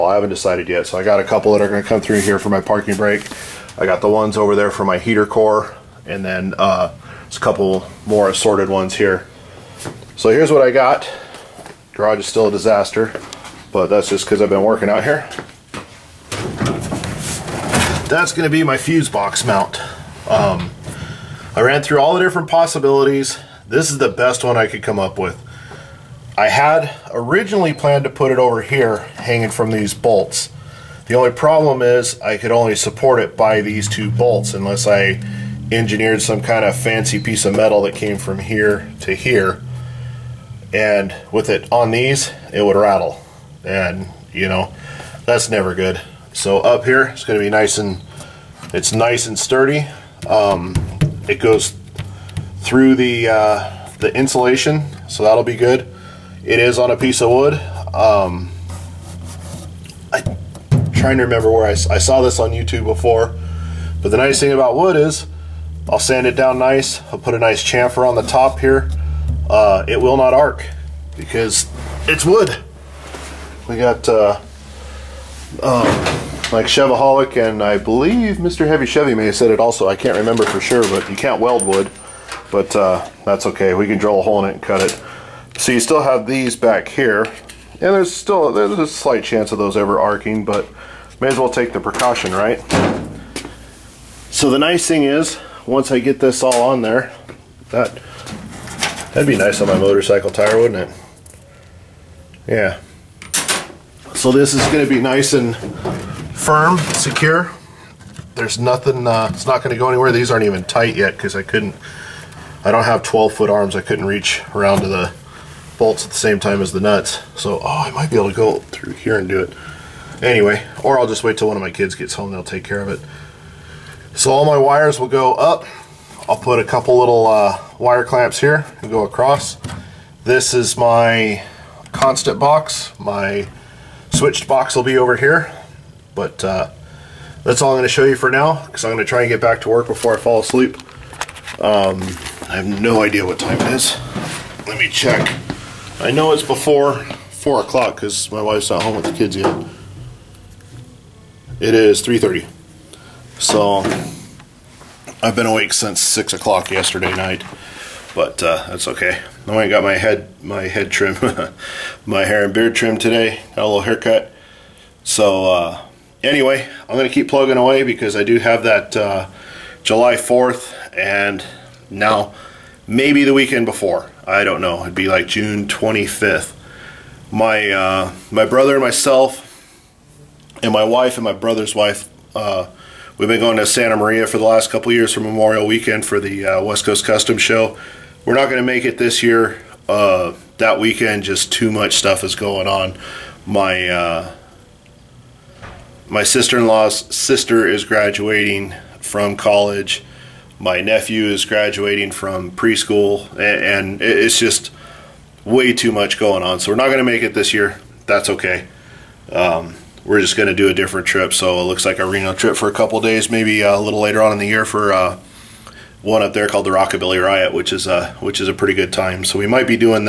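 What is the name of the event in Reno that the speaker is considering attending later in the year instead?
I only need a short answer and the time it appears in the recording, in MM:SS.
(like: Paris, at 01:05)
Rockabilly Riot, at 03:36.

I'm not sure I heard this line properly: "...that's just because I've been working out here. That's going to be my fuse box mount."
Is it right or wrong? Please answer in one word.
right.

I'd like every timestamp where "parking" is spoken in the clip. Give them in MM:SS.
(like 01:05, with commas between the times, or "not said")
00:02.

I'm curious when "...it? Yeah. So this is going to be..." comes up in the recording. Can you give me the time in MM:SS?
01:40.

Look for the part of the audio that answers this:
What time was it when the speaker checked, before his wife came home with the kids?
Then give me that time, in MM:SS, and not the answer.
02:31.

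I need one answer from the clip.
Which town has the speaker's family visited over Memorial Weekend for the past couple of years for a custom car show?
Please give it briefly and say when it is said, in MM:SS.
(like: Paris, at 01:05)
Santa Maria, at 03:03.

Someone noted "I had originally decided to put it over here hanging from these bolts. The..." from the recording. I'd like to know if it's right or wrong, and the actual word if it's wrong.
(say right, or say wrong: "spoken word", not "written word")
wrong: "planned", not "decided".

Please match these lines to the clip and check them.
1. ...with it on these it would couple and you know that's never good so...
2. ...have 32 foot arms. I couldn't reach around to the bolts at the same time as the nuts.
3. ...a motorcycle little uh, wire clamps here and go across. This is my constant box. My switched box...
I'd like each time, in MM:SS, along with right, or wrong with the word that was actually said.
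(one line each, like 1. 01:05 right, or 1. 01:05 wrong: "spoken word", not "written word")
1. 00:41 wrong: "rattle", not "couple"
2. 01:52 wrong: "12", not "32"
3. 02:06 wrong: "couple", not "motorcycle".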